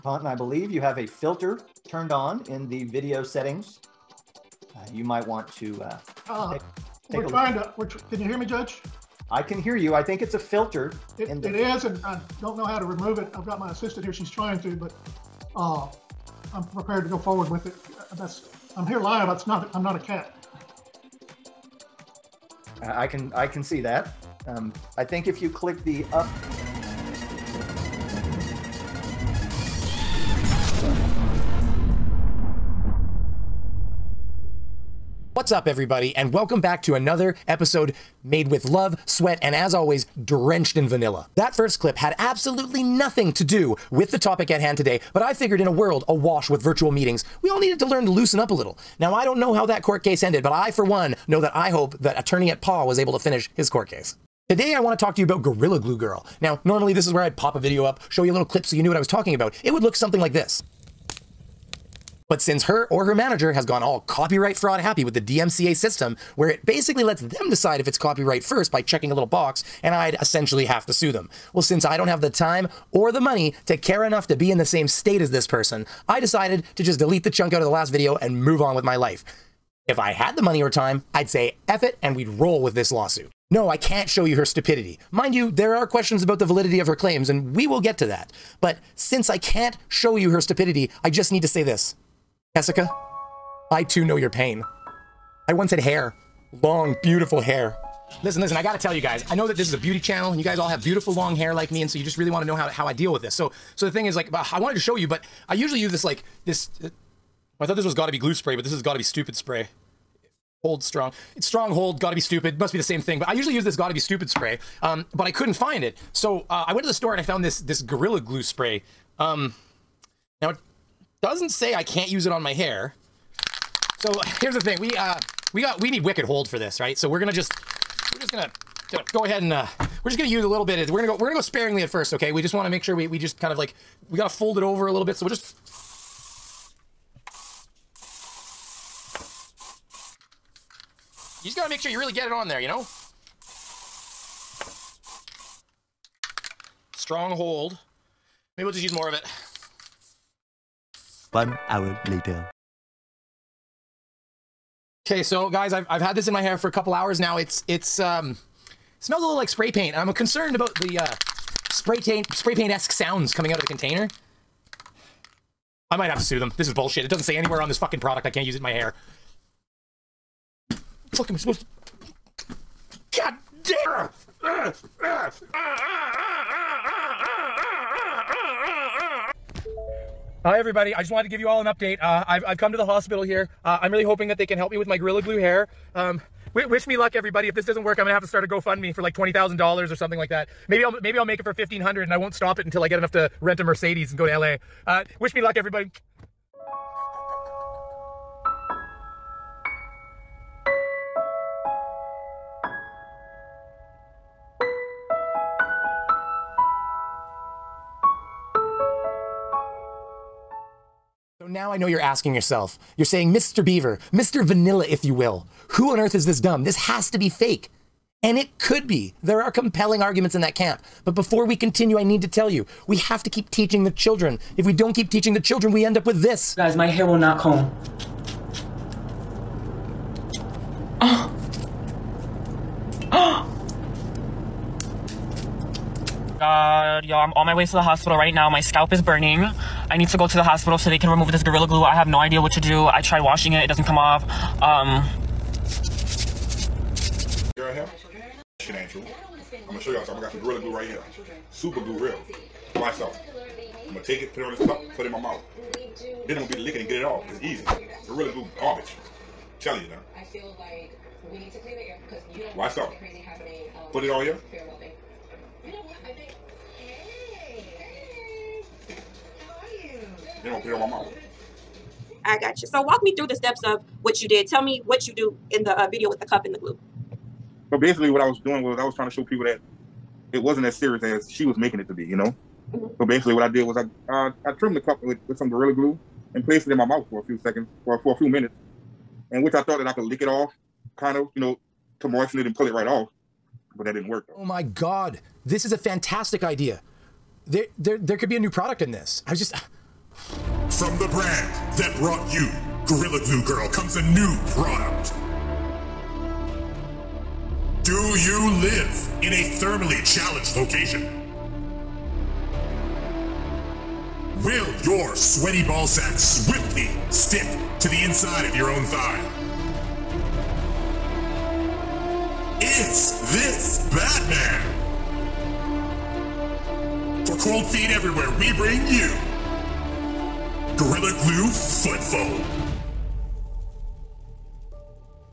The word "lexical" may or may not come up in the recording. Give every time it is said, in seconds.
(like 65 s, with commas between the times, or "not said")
not said.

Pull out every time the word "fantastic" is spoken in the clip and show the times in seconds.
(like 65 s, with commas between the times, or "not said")
295 s.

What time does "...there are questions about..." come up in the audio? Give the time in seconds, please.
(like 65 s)
85 s.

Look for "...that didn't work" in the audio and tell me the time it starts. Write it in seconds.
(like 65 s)
293 s.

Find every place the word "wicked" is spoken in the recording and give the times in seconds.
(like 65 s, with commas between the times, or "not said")
126 s.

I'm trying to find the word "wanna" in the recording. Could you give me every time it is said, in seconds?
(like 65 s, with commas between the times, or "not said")
102 s, 132 s.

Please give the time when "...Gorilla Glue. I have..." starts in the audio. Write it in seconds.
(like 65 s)
241 s.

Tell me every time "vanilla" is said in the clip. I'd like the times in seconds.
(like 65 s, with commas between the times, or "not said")
40 s, 214 s.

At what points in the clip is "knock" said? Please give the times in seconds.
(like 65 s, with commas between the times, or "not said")
not said.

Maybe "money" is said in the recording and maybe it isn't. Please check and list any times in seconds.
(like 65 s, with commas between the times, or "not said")
73 s, 80 s.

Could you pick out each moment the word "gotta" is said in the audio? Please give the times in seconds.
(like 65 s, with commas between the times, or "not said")
98 s, 134 s, 141 s.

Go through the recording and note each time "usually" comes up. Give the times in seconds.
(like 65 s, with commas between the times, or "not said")
105 s, 113 s.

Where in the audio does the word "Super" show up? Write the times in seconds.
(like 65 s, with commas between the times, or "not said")
251 s.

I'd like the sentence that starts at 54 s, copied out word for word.
Today I want to talk to you about Gorilla Glue Girl.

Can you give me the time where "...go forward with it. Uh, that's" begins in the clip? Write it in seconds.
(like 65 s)
17 s.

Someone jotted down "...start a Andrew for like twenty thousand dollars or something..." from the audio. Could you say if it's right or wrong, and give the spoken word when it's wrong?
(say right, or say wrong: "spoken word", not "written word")
wrong: "GoFundMe", not "Andrew".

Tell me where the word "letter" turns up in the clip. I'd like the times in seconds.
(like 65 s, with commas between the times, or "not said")
not said.